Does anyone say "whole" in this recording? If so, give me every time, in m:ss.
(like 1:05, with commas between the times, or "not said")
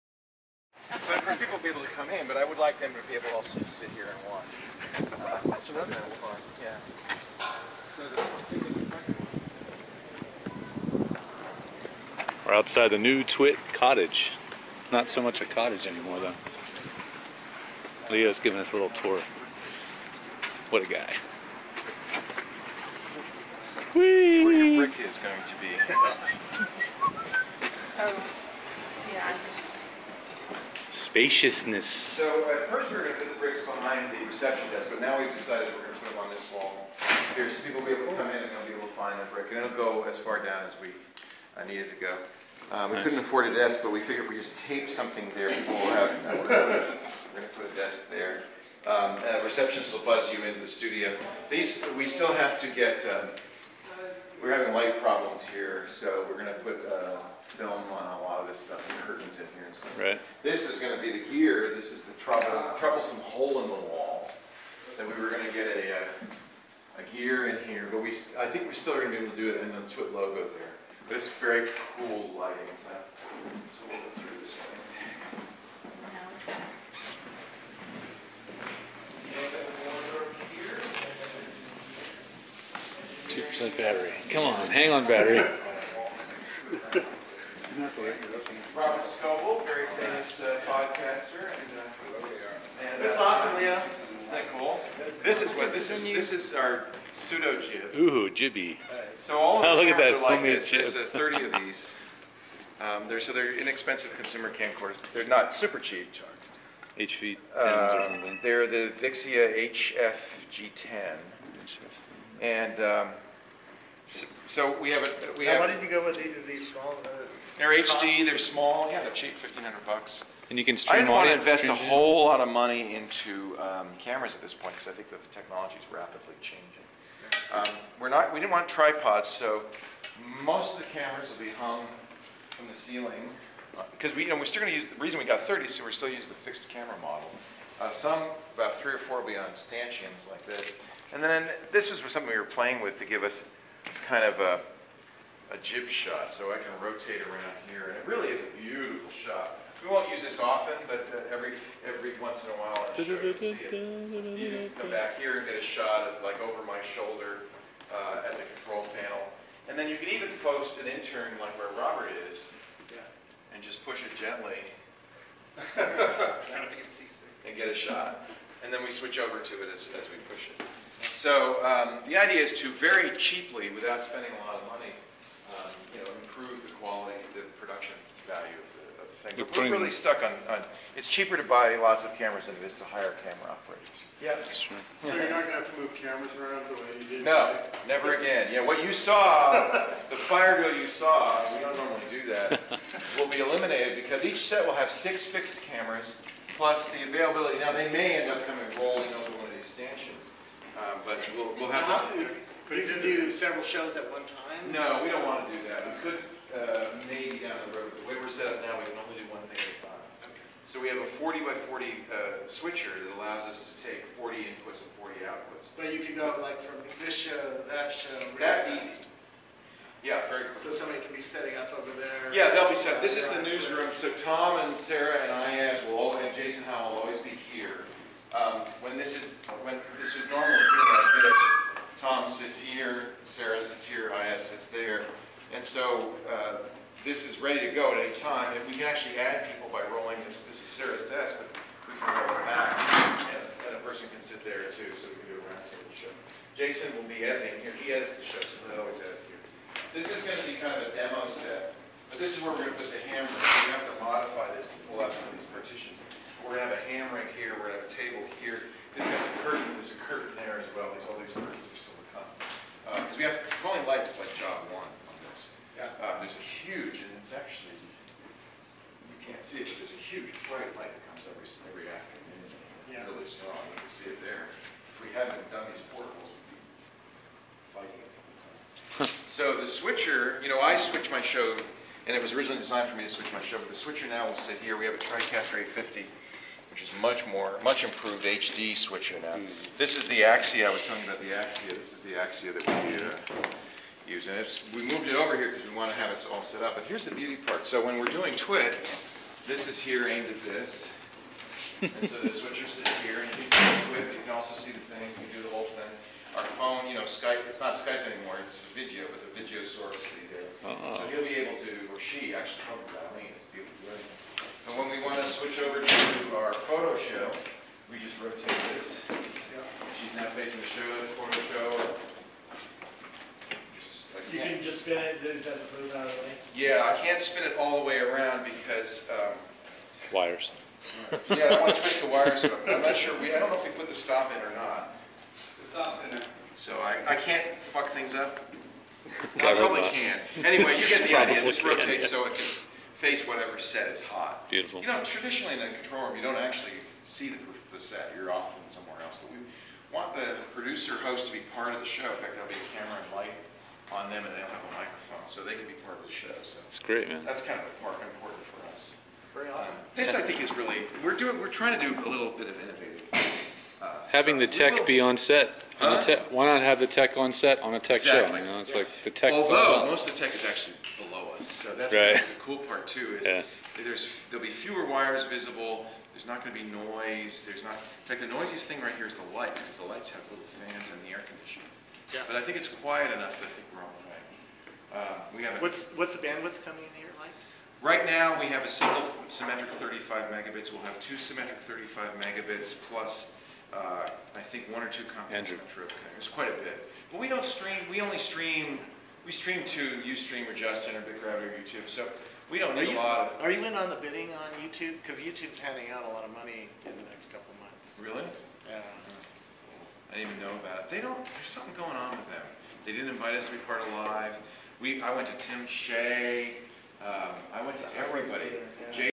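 2:01, 5:05.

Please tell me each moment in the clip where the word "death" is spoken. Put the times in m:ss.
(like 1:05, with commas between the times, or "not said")
not said.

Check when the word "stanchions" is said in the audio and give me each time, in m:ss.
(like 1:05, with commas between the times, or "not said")
2:19, 3:19.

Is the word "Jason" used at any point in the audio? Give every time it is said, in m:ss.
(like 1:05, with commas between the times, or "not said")
3:46, 4:06.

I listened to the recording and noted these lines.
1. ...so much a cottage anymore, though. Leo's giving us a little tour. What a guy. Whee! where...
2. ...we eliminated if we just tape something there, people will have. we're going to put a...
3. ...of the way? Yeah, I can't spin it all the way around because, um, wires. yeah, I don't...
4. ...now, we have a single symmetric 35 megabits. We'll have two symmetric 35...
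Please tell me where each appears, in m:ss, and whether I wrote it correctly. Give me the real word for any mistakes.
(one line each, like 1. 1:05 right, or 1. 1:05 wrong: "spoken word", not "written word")
1. 0:15 right
2. 0:43 wrong: "figured", not "eliminated"
3. 5:26 right
4. 6:28 right.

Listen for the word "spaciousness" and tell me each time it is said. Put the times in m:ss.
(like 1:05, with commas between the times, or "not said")
0:31.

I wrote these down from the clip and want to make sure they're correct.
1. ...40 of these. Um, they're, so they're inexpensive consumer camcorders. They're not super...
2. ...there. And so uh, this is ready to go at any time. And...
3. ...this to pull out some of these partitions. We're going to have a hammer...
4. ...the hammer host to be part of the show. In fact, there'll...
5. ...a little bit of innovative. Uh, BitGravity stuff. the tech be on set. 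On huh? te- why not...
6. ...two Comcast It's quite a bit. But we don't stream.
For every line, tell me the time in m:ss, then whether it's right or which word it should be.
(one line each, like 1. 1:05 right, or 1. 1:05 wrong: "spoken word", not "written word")
1. 1:41 wrong: "30", not "40"
2. 3:54 right
3. 4:14 right
4. 5:50 wrong: "producer", not "hammer"
5. 6:02 wrong: "Having", not "BitGravity"
6. 6:34 right.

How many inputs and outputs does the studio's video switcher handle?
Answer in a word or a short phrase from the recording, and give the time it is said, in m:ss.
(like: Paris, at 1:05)
40, at 3:31.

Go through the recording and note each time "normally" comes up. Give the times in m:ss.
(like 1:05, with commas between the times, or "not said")
3:11, 3:50.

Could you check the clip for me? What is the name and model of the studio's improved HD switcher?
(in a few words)
TriCaster 850.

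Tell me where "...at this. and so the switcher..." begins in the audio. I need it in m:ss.
5:00.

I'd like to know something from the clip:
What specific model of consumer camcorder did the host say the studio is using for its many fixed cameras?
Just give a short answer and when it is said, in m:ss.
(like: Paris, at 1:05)
Vixia HFG10, at 1:48.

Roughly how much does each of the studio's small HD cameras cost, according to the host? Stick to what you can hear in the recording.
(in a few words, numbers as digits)
1500 bucks.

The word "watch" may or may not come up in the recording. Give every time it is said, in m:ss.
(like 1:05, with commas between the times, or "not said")
0:04.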